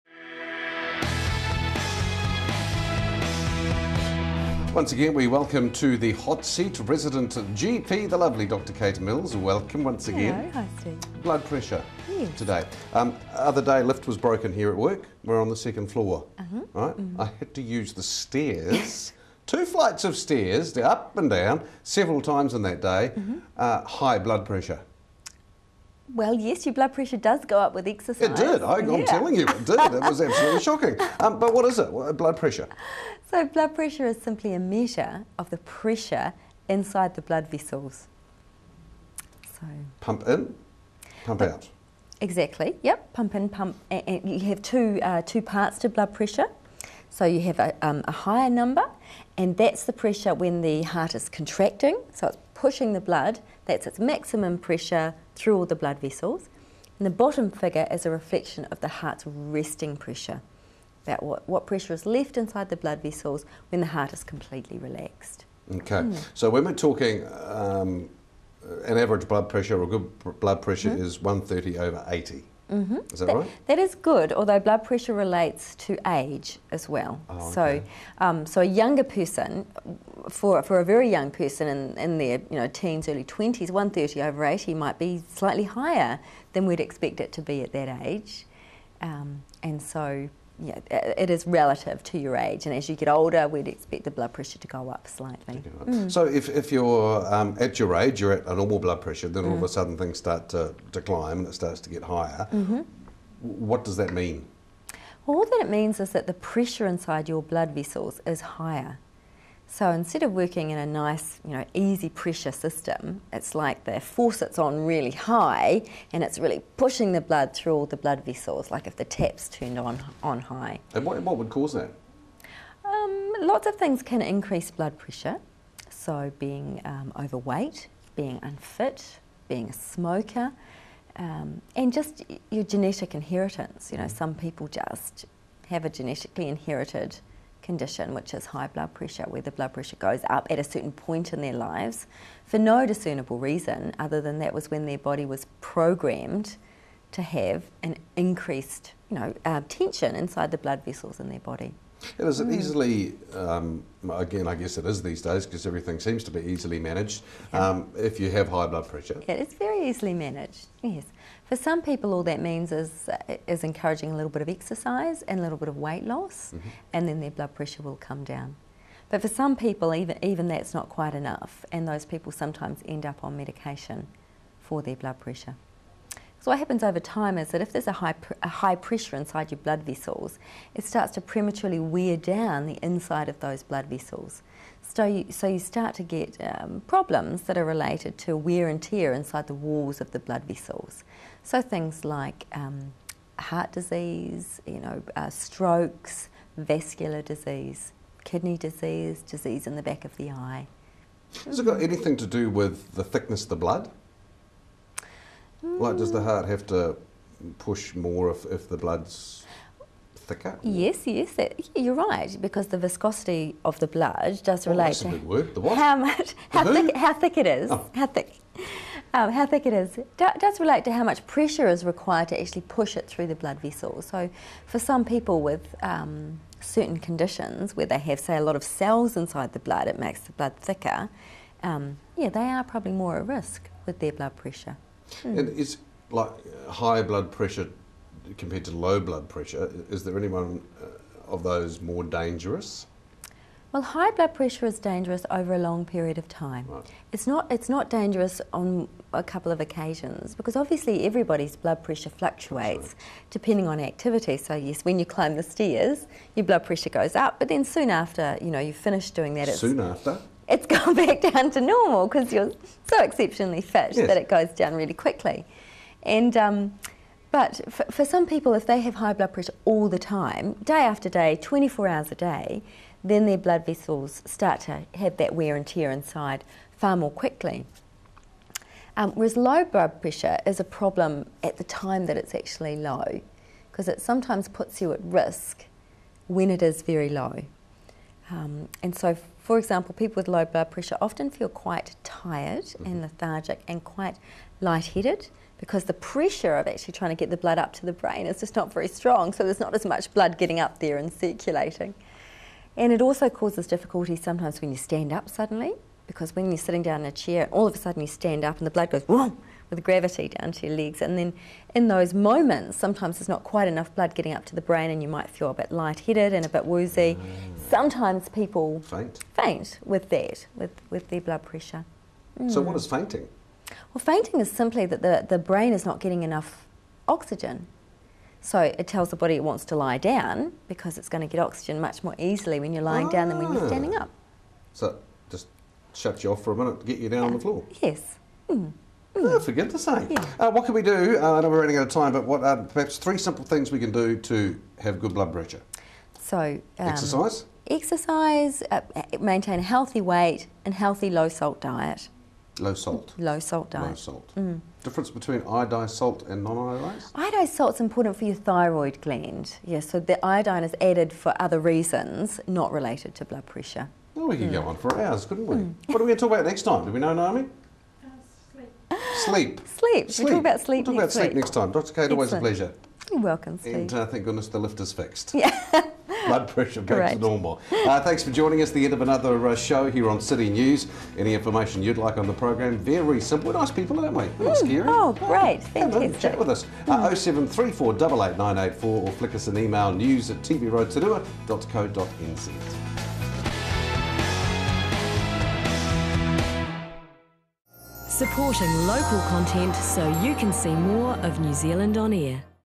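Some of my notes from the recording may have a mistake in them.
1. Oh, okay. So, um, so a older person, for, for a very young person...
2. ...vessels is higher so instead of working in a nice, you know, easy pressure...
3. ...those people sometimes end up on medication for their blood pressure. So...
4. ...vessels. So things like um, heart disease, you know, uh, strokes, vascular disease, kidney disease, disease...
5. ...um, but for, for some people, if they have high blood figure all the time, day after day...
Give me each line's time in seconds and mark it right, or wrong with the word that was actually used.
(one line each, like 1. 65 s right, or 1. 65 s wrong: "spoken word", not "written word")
1. 77 s wrong: "younger", not "older"
2. 107 s right
3. 171 s right
4. 190 s right
5. 266 s wrong: "pressure", not "figure".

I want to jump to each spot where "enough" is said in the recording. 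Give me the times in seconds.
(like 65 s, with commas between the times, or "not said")
171 s, 313 s, 326 s.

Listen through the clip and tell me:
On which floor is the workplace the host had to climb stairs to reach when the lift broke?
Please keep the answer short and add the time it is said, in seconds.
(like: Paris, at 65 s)
second floor, at 15 s.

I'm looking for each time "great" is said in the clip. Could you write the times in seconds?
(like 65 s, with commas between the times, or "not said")
376 s, 385 s.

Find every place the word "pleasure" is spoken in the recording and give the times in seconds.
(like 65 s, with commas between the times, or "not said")
372 s.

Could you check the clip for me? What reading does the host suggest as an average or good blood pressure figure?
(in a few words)
130 over 80.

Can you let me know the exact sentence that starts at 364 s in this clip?
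go on for hours, couldn't we?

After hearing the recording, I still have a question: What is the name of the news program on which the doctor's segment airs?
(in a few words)
City News.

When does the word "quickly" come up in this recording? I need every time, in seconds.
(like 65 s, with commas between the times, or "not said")
264 s, 277 s.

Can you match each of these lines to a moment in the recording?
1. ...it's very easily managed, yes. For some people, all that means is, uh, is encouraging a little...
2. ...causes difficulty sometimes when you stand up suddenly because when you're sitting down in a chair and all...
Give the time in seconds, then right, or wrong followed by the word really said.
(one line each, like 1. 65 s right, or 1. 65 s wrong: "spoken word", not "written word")
1. 159 s right
2. 303 s right.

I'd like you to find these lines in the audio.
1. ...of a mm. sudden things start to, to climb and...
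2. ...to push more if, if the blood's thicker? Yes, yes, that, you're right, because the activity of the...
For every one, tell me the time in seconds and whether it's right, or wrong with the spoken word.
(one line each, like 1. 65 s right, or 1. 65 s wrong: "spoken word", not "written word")
1. 99 s right
2. 206 s wrong: "viscosity", not "activity".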